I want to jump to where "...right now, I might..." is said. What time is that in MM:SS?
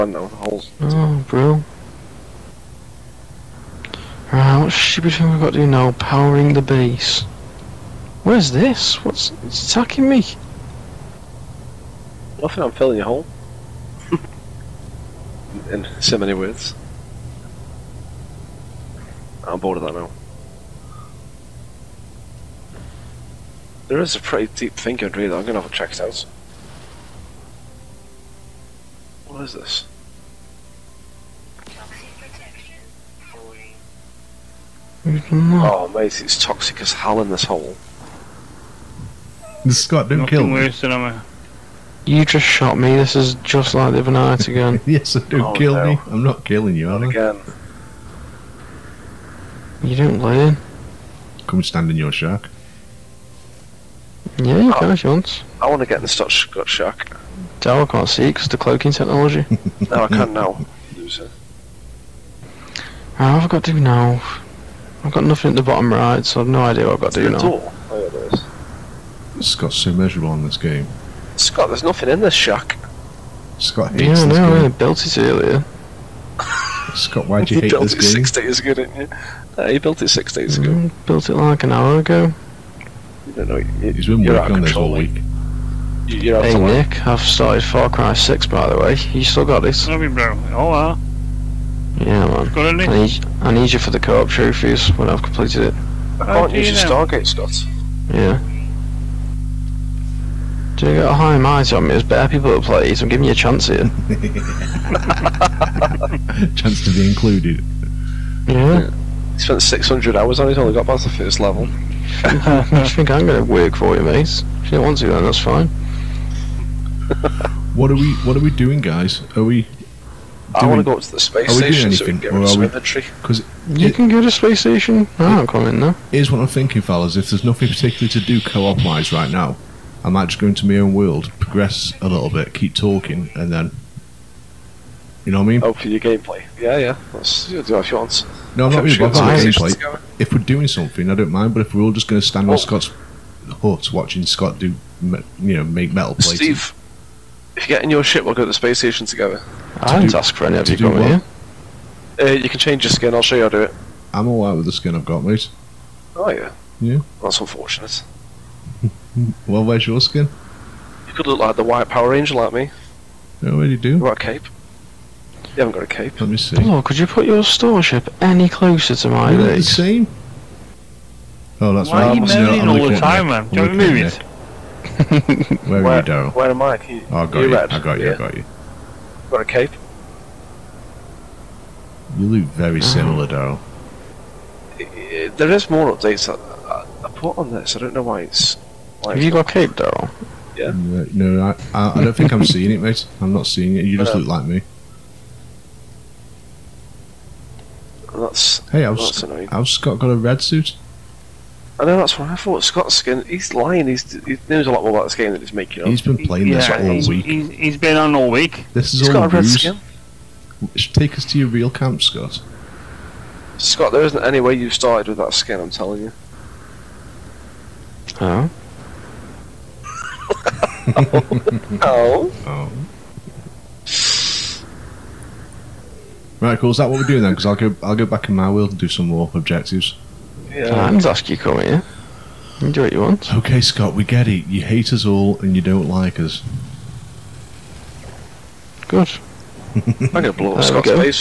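02:09.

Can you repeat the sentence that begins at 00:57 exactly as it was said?
I can't see because the cloaking technology.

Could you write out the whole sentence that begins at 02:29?
I didn't ask for any of you coming with you.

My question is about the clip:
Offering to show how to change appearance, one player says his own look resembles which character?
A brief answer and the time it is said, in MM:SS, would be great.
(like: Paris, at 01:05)
White Power Ranger, at 02:41.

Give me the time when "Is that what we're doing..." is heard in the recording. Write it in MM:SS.
03:46.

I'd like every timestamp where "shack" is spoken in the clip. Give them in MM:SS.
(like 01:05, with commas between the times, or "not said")
00:52, 01:12.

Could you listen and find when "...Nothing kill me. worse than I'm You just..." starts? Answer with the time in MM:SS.
00:40.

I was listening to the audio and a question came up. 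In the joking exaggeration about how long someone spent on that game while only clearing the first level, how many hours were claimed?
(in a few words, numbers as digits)
600.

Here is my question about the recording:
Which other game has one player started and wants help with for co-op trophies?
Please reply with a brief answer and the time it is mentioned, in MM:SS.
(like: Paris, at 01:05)
Far Cry 6, at 01:27.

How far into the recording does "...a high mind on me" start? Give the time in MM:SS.
01:41.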